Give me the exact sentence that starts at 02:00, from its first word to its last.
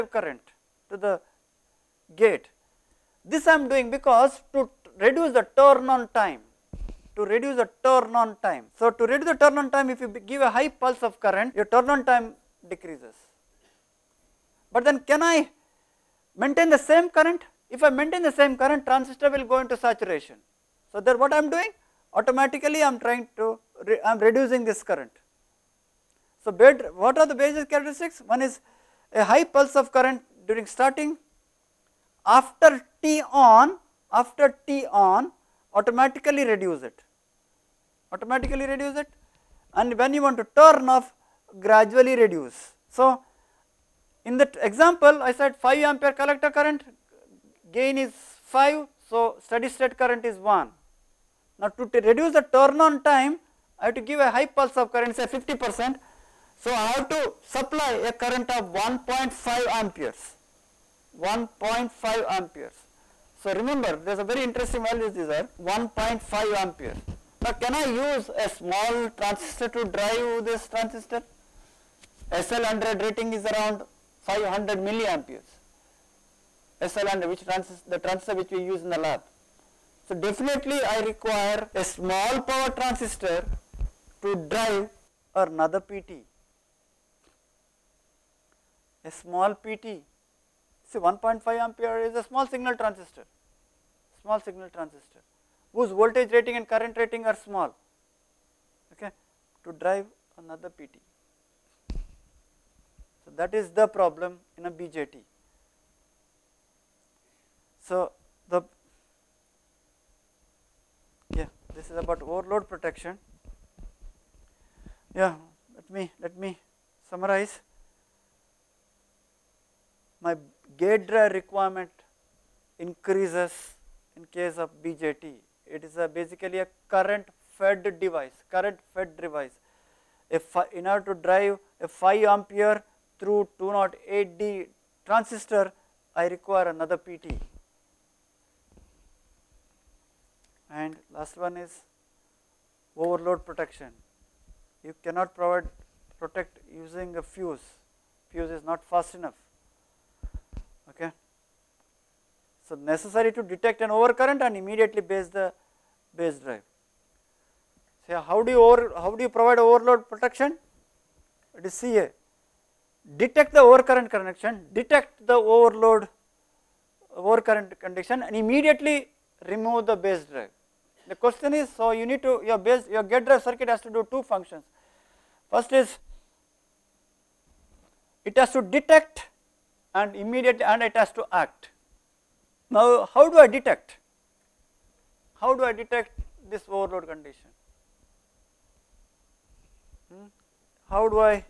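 My gate drive requirement increases in case of BJT.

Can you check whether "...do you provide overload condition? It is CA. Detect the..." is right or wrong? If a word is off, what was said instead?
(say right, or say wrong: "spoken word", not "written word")
wrong: "protection", not "condition".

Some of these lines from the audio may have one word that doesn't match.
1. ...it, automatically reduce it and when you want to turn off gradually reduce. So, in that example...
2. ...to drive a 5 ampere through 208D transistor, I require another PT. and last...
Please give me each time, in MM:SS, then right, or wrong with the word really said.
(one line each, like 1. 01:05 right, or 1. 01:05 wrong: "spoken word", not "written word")
1. 00:36 right
2. 02:11 right.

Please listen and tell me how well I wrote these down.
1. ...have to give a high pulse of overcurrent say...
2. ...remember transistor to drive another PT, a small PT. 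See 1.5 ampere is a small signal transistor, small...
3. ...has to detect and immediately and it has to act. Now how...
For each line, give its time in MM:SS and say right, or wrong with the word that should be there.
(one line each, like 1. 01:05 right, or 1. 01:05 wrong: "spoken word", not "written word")
1. 00:53 wrong: "current", not "overcurrent"
2. 01:22 wrong: "power", not "remember"
3. 02:58 right.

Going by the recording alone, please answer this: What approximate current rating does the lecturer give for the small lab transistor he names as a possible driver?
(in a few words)
500 milliamperes.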